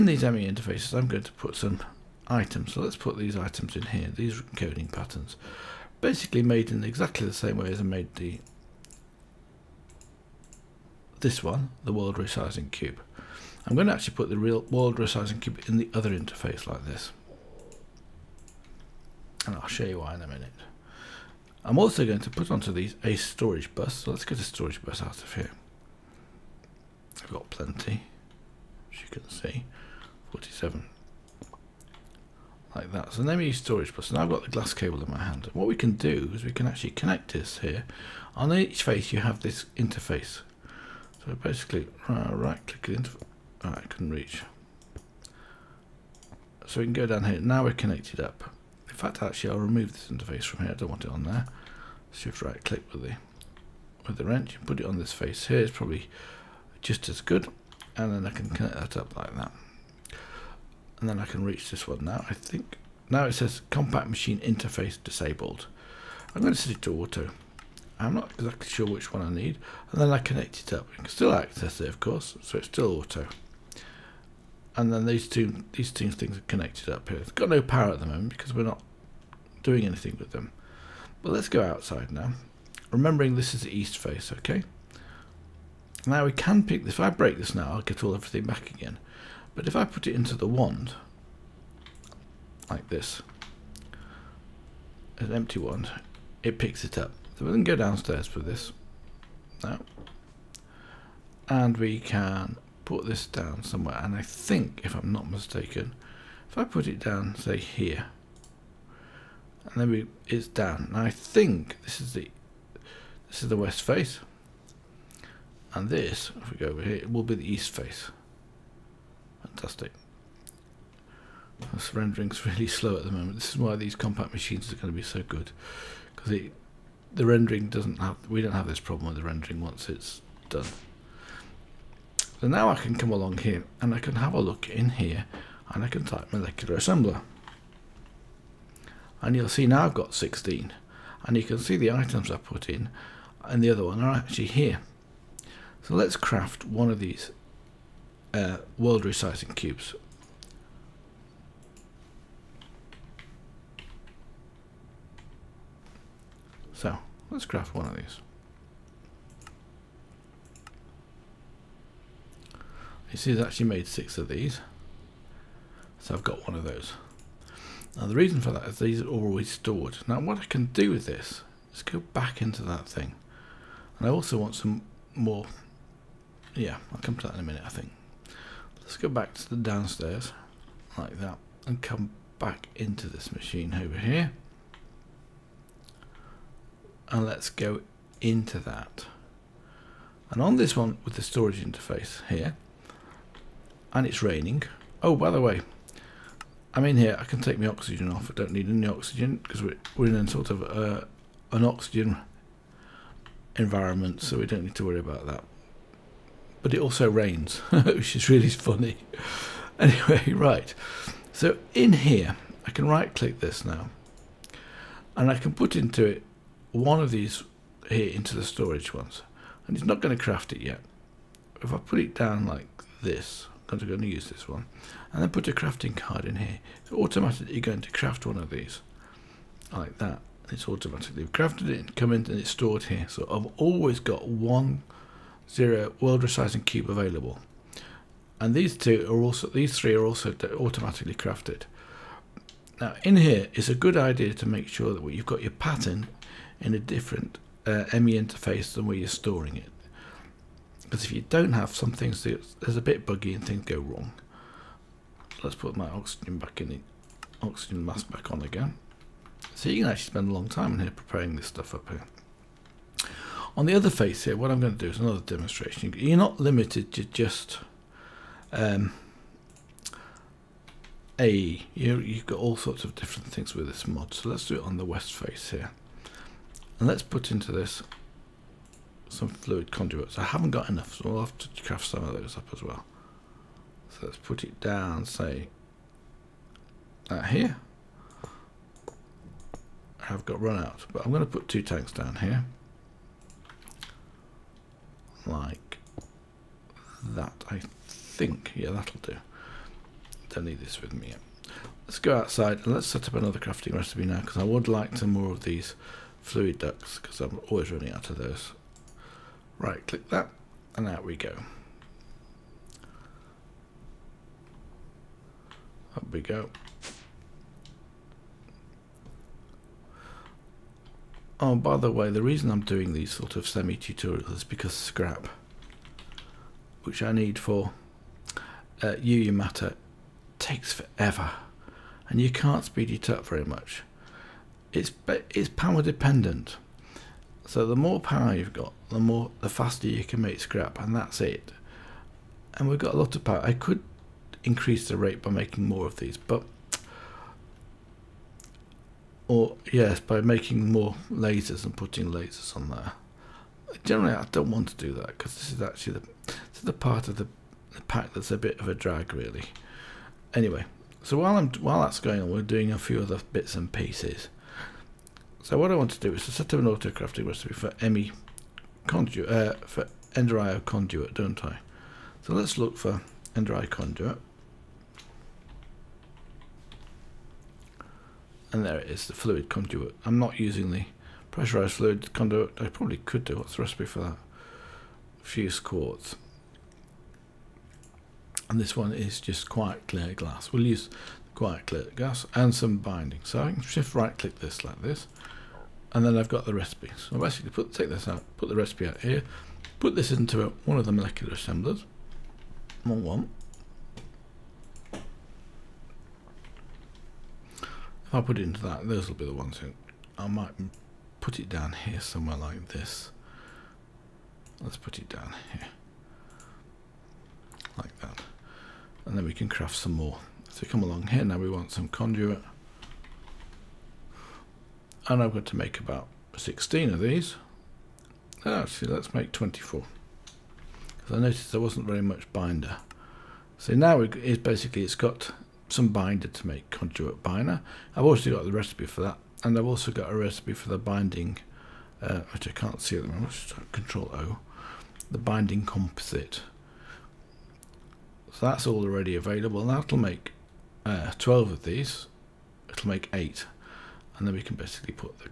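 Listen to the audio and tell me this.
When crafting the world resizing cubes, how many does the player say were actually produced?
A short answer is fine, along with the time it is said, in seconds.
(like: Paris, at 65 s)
six, at 163 s.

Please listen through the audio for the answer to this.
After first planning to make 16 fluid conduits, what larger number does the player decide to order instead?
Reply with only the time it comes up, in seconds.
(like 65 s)
429 s.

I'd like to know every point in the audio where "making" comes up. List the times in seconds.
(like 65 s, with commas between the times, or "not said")
345 s, 350 s.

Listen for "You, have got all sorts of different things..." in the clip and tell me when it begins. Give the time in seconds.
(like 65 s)
271 s.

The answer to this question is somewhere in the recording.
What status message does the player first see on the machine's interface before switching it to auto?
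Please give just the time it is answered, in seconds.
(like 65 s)
63 s.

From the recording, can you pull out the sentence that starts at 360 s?
Anyway, so while I'm while that's going on, we're doing a few other bits and pieces.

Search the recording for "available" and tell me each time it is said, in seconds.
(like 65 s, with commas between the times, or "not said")
236 s, 449 s.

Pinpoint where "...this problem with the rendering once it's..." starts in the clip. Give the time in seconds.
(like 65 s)
128 s.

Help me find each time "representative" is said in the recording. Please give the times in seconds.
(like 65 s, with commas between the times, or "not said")
not said.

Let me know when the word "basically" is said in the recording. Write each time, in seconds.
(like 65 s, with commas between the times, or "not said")
6 s, 41 s, 397 s, 434 s, 454 s.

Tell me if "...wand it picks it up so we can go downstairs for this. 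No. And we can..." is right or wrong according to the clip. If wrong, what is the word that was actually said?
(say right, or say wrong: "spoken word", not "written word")
right.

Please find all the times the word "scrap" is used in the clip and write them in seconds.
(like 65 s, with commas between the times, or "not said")
324 s, 340 s.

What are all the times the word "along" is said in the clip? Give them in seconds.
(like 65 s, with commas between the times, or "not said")
133 s, 420 s.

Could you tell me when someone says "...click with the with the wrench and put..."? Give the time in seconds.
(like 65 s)
52 s.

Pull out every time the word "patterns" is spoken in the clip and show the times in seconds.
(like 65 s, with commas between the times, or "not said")
4 s, 245 s.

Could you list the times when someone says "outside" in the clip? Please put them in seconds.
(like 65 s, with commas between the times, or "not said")
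81 s, 302 s.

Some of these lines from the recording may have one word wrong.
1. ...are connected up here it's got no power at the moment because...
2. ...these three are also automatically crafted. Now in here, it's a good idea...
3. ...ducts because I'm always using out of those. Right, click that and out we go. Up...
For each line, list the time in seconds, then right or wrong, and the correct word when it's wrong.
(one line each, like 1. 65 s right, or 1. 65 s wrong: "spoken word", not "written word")
1. 76 s right
2. 239 s right
3. 306 s wrong: "running", not "using".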